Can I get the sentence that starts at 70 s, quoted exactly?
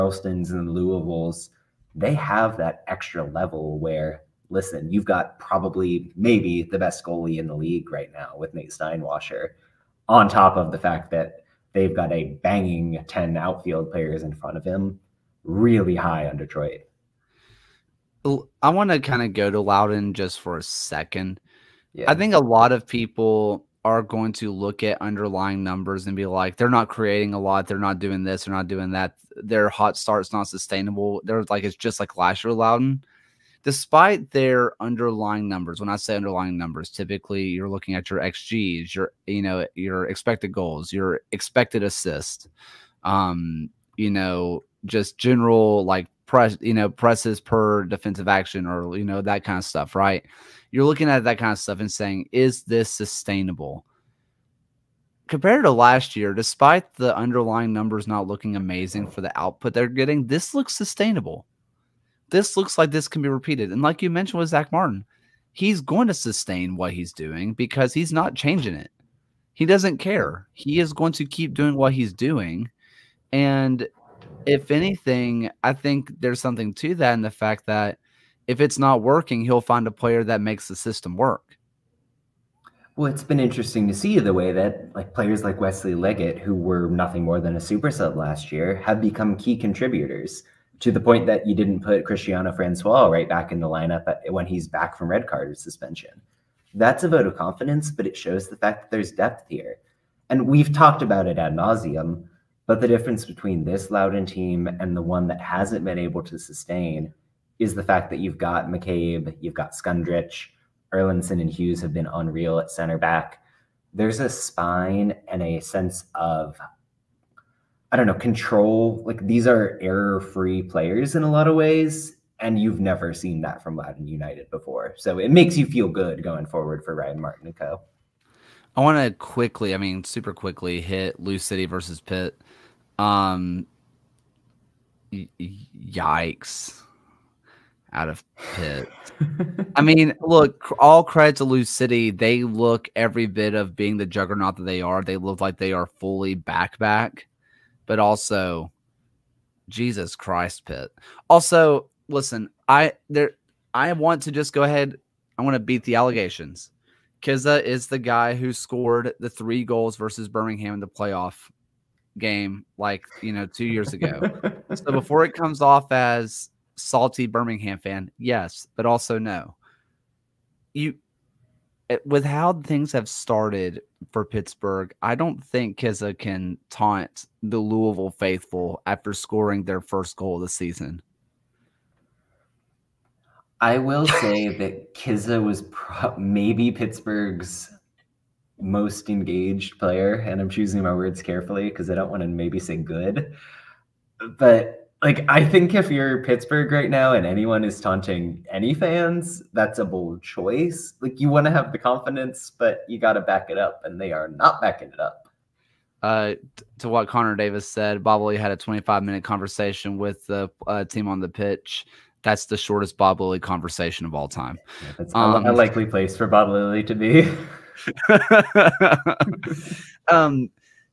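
He is going to keep doing what he's doing.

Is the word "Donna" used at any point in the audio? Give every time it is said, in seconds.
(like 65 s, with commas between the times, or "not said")
not said.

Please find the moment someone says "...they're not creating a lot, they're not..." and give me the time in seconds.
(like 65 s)
26 s.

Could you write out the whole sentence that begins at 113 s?
There's a spine and a sense of, I don't know, control.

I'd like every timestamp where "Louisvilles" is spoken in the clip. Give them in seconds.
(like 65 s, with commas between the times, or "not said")
0 s, 177 s.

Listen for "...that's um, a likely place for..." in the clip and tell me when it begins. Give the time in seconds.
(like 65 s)
214 s.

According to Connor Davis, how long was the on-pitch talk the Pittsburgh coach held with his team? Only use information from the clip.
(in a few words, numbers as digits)
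25 minutes.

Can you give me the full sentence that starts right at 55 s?
Compared to last year, despite the underlying numbers not looking amazing for the output they're getting, this looks sustainable.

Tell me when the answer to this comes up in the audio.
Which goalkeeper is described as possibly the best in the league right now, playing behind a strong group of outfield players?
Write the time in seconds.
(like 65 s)
8 s.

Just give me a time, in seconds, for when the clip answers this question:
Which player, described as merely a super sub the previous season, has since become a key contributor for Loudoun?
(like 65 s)
85 s.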